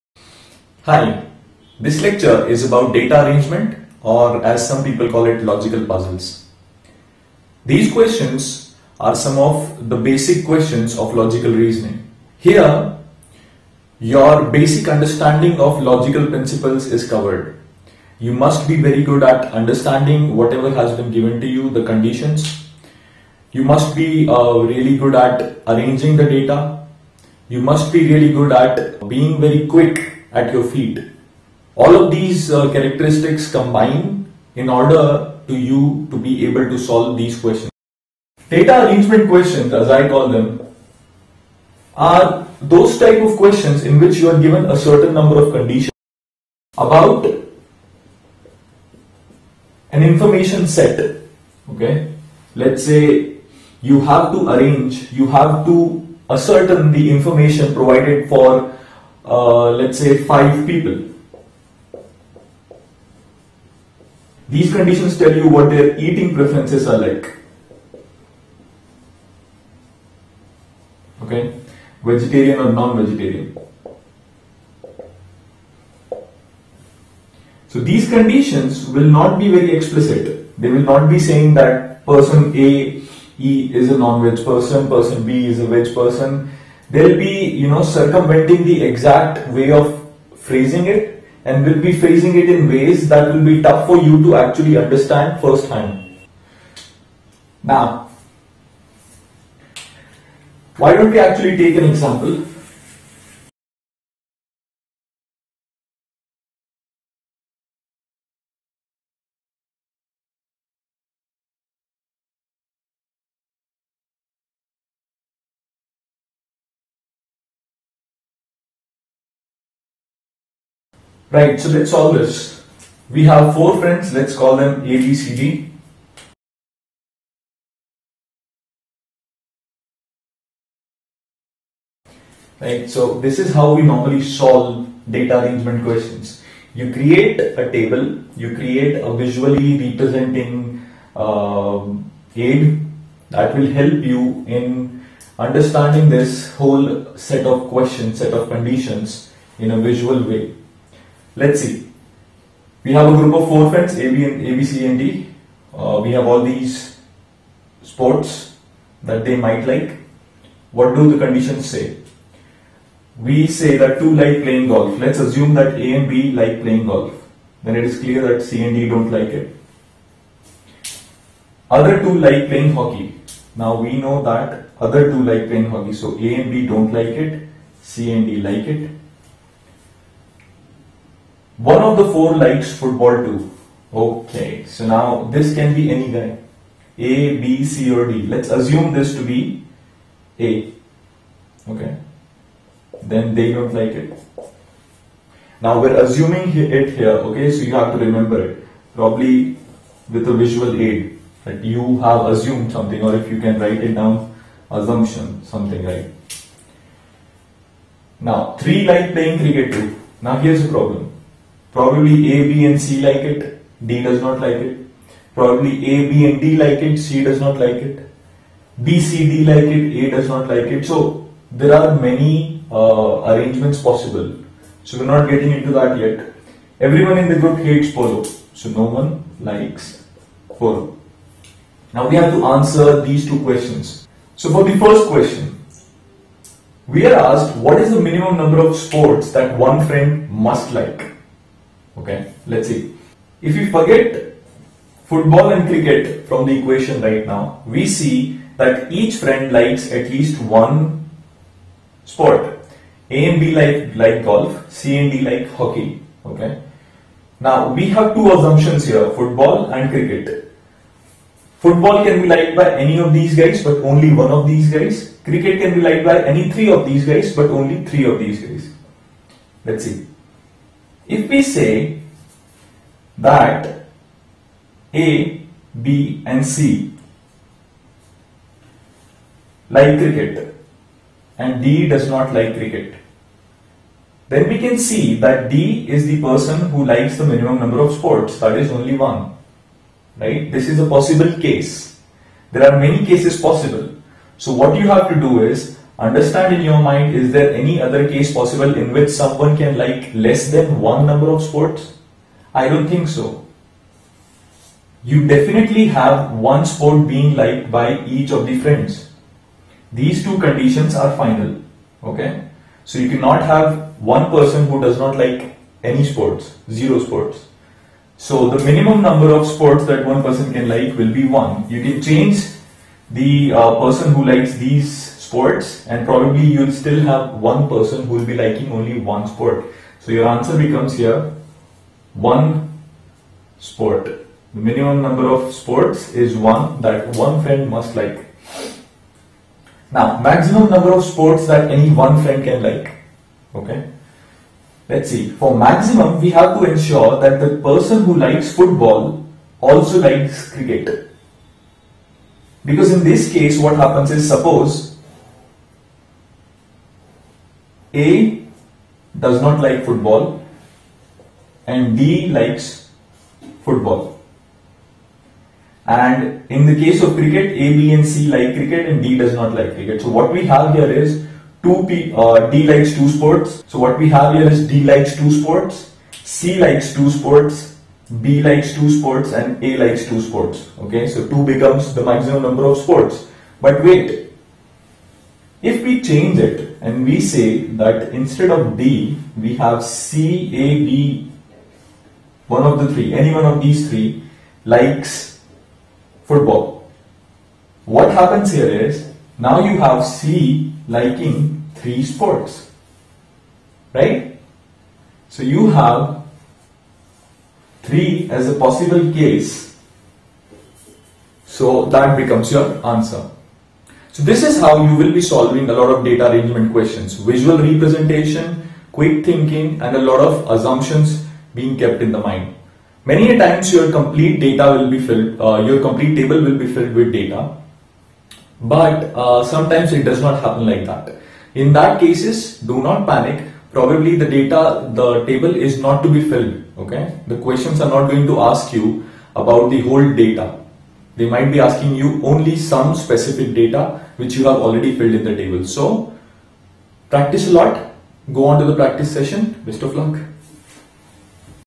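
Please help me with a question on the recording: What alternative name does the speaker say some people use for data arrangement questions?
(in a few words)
logical puzzles.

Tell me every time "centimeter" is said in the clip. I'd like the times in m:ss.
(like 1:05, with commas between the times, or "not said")
not said.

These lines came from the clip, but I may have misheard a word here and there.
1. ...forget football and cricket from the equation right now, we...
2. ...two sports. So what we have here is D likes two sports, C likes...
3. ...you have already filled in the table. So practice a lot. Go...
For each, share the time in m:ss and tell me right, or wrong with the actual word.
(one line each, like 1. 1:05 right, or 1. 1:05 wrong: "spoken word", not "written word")
1. 4:03 right
2. 6:12 right
3. 7:24 right.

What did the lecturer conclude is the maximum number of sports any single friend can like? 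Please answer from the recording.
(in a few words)
3.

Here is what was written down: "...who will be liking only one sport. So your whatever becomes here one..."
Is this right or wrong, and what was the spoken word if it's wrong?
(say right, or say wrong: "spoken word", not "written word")
wrong: "answer", not "whatever".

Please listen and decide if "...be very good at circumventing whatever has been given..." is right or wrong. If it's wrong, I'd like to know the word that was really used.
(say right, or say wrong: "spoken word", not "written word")
wrong: "understanding", not "circumventing".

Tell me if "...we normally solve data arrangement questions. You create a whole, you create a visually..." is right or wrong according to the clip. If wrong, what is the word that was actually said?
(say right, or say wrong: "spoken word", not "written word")
wrong: "table", not "whole".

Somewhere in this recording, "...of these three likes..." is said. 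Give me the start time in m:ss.
6:33.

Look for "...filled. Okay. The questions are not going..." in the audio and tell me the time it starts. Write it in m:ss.
7:16.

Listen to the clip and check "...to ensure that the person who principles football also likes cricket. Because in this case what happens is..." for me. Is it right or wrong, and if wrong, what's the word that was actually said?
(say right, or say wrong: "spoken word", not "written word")
wrong: "likes", not "principles".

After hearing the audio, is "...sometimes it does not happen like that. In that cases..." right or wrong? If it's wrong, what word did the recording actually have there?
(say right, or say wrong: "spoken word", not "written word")
right.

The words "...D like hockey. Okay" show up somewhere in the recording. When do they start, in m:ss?
4:15.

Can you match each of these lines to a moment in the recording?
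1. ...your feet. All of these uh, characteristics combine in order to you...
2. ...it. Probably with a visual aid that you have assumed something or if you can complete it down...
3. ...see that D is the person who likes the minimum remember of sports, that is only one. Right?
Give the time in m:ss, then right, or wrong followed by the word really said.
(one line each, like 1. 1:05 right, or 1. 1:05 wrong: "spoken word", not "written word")
1. 0:30 right
2. 3:18 wrong: "write", not "complete"
3. 4:44 wrong: "number", not "remember".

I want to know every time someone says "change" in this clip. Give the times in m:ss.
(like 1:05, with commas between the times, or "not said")
5:22, 6:26.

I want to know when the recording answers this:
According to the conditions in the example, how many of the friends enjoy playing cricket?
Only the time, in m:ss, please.
3:28.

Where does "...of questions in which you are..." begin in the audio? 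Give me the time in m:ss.
0:43.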